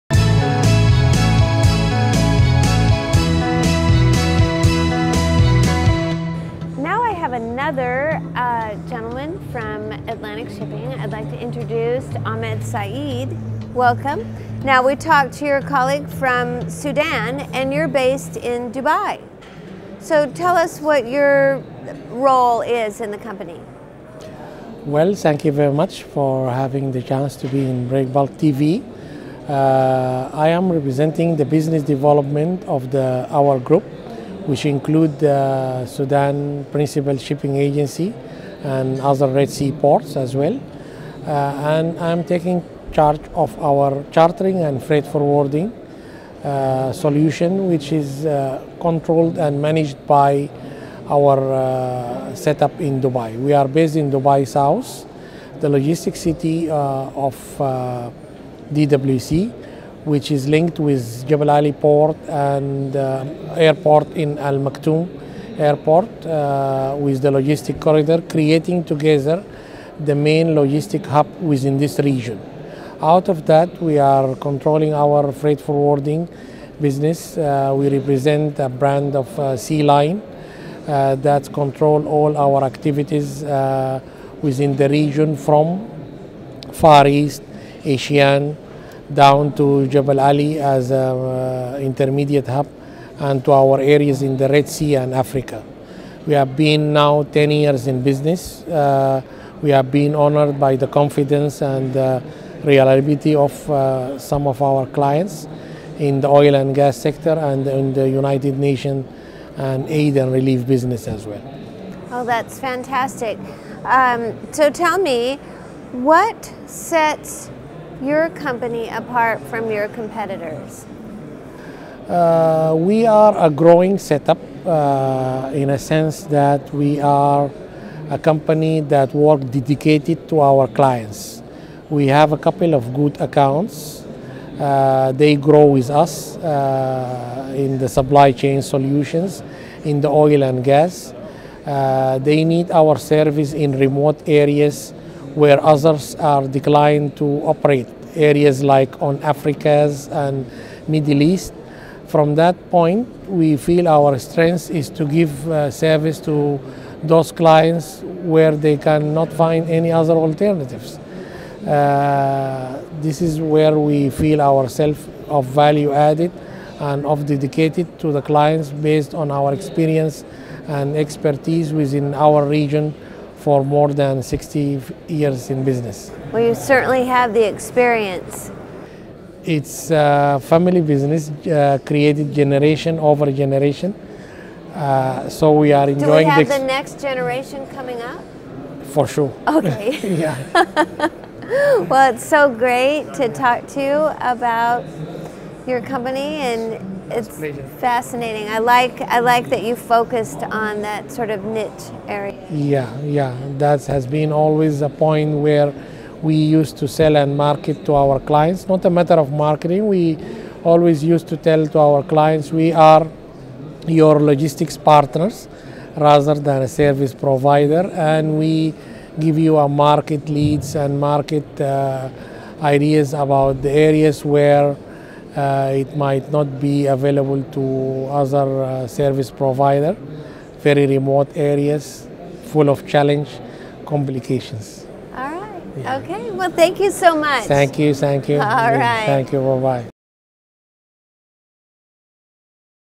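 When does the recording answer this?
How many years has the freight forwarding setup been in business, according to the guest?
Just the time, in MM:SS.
01:37.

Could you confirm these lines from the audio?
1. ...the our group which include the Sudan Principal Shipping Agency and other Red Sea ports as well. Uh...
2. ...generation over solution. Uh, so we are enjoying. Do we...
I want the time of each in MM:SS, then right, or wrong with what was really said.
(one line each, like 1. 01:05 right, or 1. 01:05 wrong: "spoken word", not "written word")
1. 00:32 right
2. 03:02 wrong: "generation", not "solution".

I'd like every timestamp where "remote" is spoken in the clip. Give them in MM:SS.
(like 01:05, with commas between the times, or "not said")
02:23, 03:50.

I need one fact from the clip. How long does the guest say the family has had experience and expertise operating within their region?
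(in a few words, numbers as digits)
more than 60 years.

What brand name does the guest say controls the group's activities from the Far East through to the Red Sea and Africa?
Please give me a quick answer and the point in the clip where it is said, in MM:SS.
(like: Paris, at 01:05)
Sea Line, at 01:19.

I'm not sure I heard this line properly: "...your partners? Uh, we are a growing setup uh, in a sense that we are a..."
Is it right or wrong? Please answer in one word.
wrong.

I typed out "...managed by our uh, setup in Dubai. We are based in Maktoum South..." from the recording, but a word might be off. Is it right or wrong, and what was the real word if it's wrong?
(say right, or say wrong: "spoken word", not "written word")
wrong: "Dubai", not "Maktoum".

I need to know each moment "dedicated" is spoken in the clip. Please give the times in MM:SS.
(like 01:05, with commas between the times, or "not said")
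02:09, 02:47.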